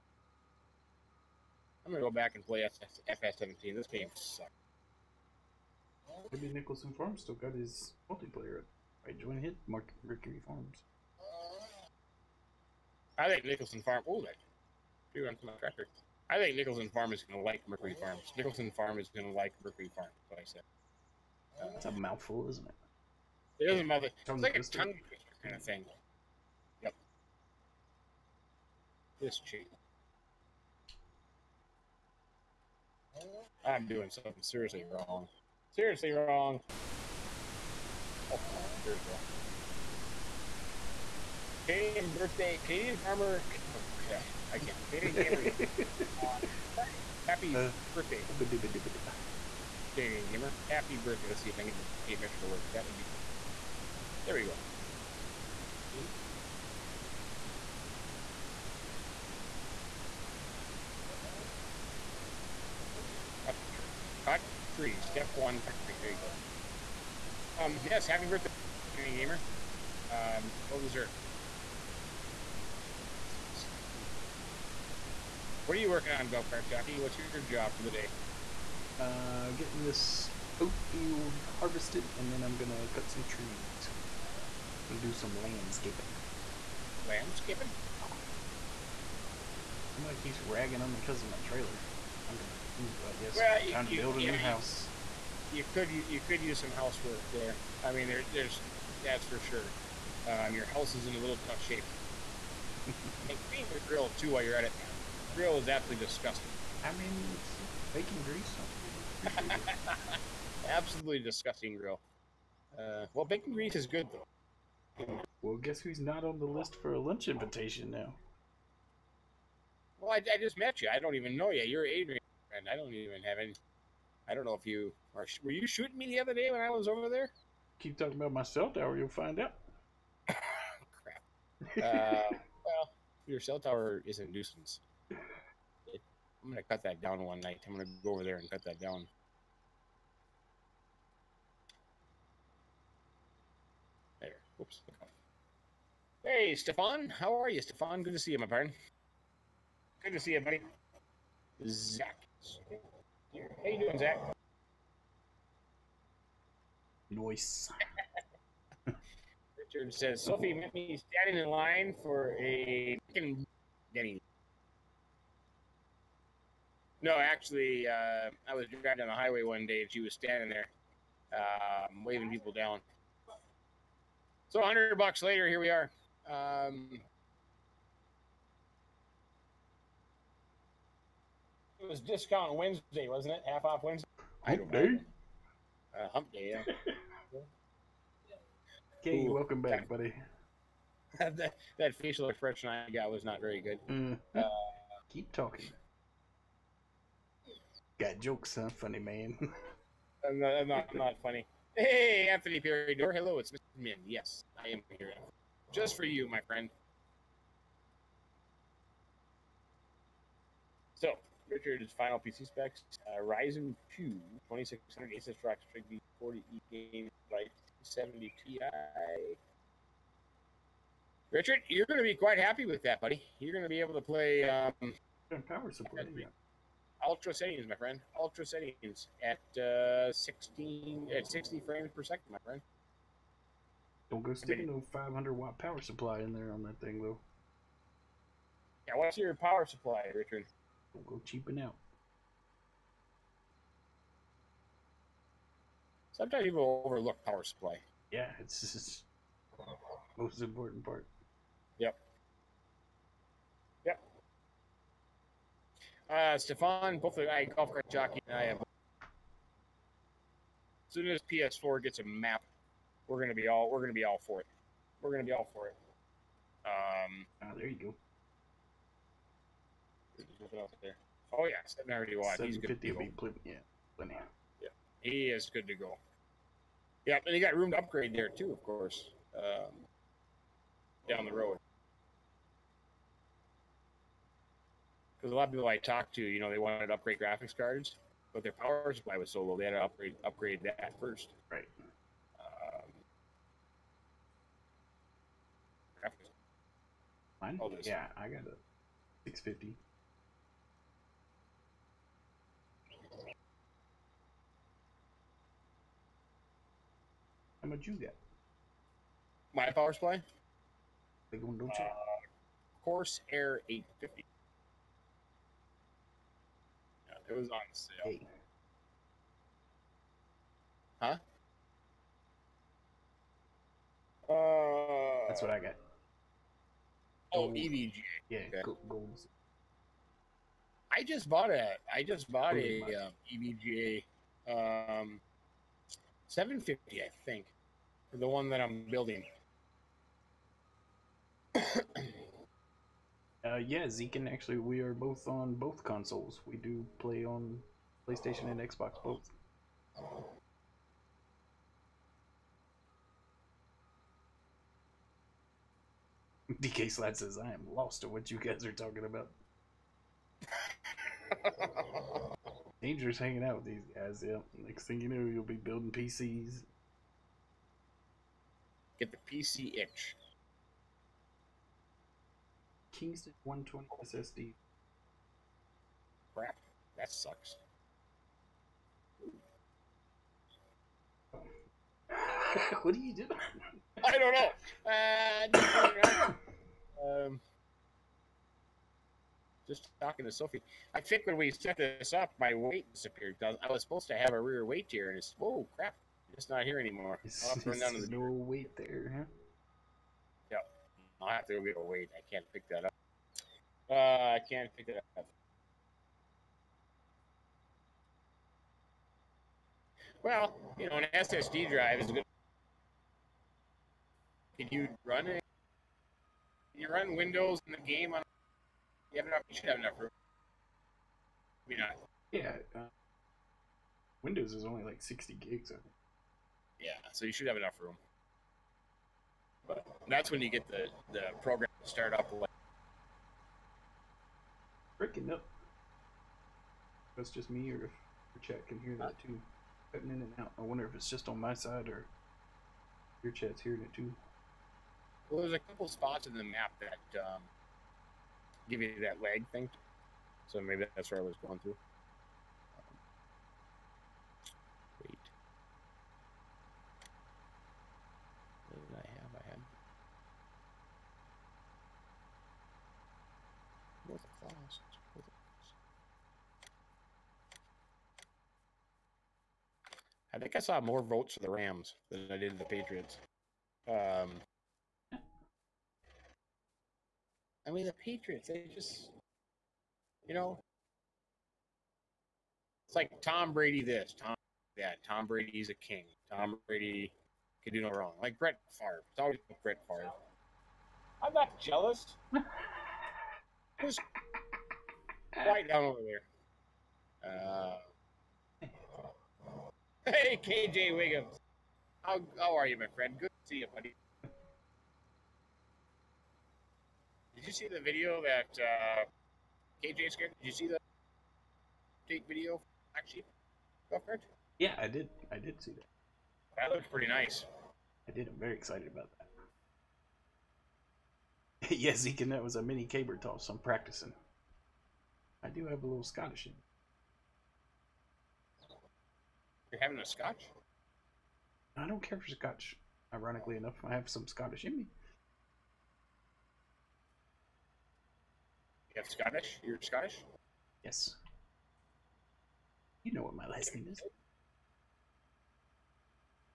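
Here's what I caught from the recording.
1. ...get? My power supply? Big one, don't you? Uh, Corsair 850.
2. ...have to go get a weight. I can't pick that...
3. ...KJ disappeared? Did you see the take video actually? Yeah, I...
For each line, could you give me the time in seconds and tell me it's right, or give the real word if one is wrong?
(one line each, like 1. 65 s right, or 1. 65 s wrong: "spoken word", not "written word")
1. 307 s right
2. 401 s right
3. 509 s wrong: "scared", not "disappeared".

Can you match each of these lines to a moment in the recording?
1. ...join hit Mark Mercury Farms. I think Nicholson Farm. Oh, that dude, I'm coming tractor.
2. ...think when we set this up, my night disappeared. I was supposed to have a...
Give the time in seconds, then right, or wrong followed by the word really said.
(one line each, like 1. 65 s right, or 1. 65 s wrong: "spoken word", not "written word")
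1. 9 s right
2. 391 s wrong: "weight", not "night".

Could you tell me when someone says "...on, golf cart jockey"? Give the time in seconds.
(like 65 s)
76 s.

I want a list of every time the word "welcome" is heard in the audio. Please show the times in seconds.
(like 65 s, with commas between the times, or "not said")
189 s.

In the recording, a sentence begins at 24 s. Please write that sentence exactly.
It's like a tongue kind of thing.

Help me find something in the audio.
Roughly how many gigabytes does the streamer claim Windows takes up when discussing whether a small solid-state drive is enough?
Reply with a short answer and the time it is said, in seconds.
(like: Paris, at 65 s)
60, at 425 s.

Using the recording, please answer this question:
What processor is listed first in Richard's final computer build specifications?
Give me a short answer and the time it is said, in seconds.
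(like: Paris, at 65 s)
Ryzen 2 2600, at 213 s.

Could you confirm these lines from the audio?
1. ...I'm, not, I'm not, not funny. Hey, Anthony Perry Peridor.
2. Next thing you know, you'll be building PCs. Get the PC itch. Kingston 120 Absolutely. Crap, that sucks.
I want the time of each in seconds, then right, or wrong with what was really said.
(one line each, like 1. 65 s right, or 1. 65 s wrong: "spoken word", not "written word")
1. 200 s right
2. 364 s wrong: "SSD", not "Absolutely".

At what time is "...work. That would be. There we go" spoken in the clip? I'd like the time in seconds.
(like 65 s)
52 s.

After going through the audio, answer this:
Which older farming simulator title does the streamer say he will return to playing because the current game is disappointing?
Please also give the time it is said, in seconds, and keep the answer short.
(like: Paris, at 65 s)
FS17, at 3 s.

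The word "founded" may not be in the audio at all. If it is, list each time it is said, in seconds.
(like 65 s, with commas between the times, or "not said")
not said.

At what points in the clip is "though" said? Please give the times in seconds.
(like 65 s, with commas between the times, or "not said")
114 s, 237 s.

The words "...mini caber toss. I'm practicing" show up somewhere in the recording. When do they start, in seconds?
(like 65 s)
522 s.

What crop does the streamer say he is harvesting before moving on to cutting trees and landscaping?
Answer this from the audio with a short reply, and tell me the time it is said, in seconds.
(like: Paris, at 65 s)
oat, at 80 s.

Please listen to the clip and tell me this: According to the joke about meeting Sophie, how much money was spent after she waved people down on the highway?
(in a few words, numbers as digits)
100 bucks.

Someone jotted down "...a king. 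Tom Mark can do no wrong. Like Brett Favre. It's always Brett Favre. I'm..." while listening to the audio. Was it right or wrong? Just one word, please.
wrong.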